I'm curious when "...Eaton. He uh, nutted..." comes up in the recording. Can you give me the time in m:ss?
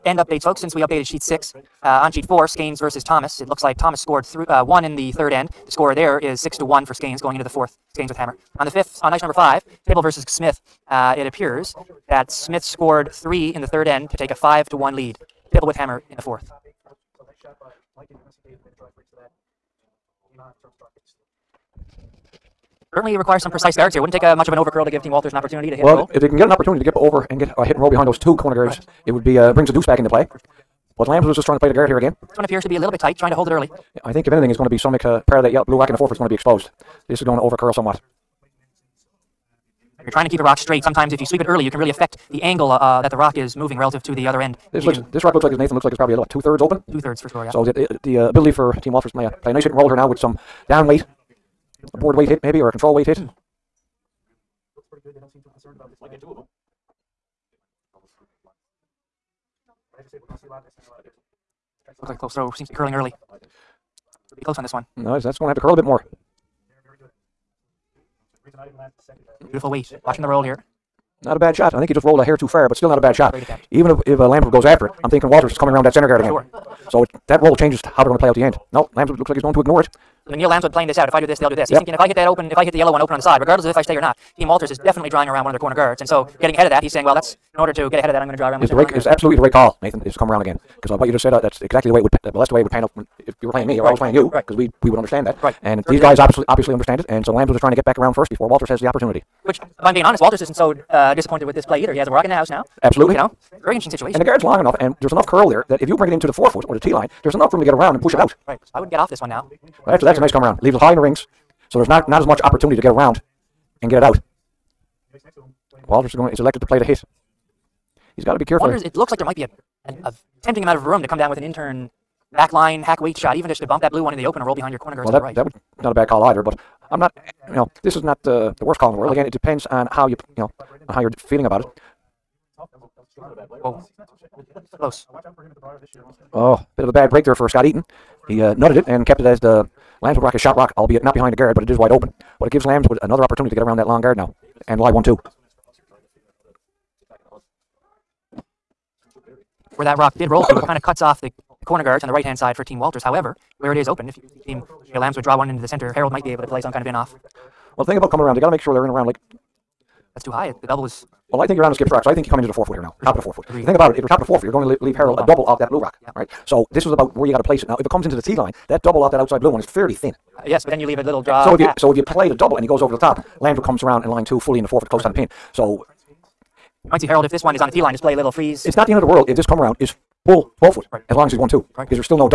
2:17.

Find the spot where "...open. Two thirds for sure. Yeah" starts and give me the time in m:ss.
0:46.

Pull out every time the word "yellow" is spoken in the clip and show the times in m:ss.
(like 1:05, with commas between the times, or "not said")
0:35, 1:22.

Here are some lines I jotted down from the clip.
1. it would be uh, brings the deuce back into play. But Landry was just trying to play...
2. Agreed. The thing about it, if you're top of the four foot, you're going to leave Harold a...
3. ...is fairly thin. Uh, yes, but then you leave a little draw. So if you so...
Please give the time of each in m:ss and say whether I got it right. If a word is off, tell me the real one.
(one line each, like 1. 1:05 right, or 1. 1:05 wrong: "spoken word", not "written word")
1. 0:29 wrong: "Lambs", not "Landry"
2. 2:43 right
3. 2:49 right.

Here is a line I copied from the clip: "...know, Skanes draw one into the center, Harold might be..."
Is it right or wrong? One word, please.
wrong.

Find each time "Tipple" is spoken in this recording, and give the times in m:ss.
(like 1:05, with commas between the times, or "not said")
0:09, 0:15.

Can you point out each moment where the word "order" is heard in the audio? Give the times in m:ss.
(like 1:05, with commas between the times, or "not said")
1:27.